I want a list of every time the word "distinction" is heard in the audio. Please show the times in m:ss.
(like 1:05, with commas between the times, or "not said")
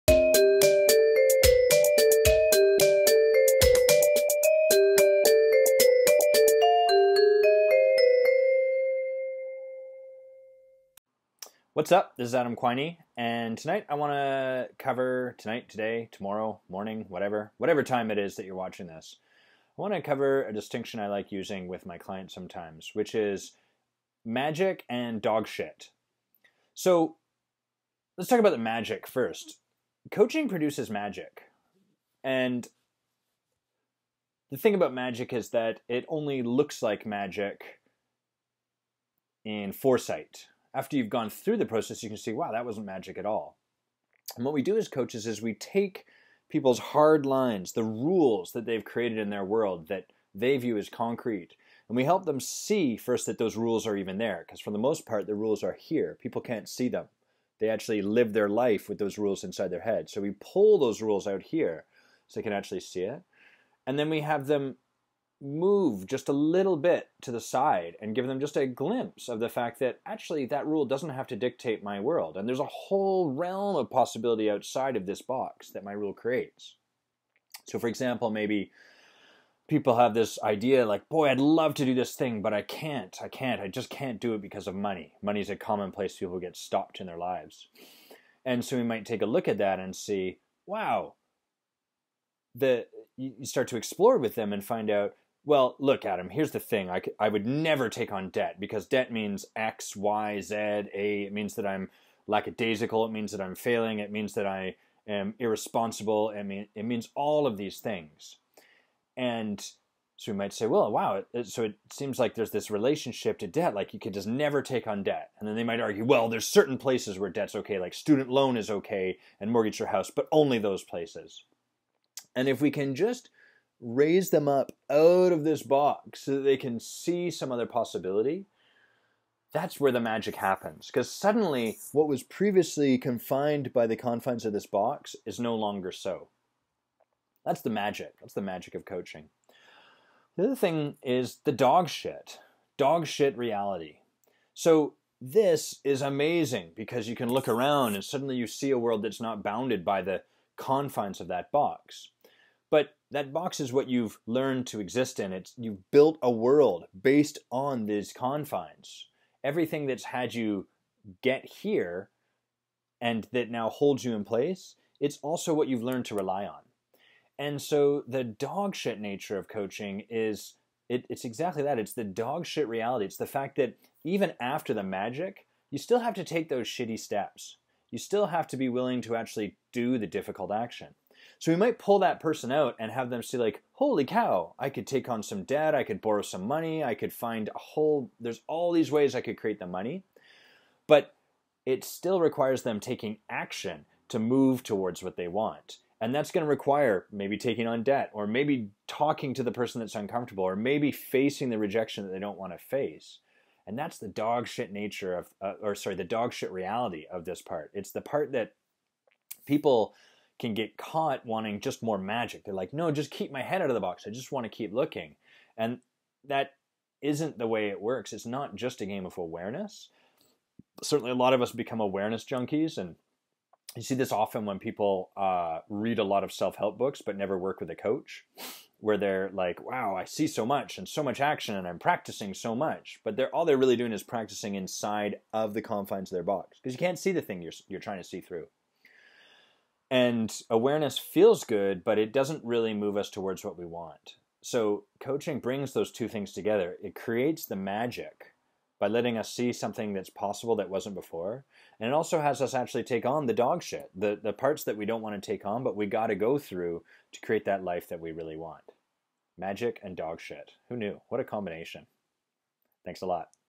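0:20.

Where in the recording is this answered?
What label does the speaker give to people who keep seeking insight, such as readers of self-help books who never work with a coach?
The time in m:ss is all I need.
3:41.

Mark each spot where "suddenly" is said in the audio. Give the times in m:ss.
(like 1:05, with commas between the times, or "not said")
2:11, 2:28.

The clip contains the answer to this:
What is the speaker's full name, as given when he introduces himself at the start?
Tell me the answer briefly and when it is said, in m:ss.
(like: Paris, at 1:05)
Adam Quiney, at 0:12.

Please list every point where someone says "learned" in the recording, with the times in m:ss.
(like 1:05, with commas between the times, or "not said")
2:34, 2:45.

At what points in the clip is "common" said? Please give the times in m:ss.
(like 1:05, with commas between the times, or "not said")
1:25.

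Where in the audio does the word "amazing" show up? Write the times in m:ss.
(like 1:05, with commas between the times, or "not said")
2:26.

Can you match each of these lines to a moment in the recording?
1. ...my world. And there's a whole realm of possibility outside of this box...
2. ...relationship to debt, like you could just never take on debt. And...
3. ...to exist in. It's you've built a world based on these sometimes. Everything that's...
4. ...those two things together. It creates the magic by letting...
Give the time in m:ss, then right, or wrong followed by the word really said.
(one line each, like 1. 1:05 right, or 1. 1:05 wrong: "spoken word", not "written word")
1. 1:11 right
2. 1:52 right
3. 2:34 wrong: "confines", not "sometimes"
4. 4:05 right.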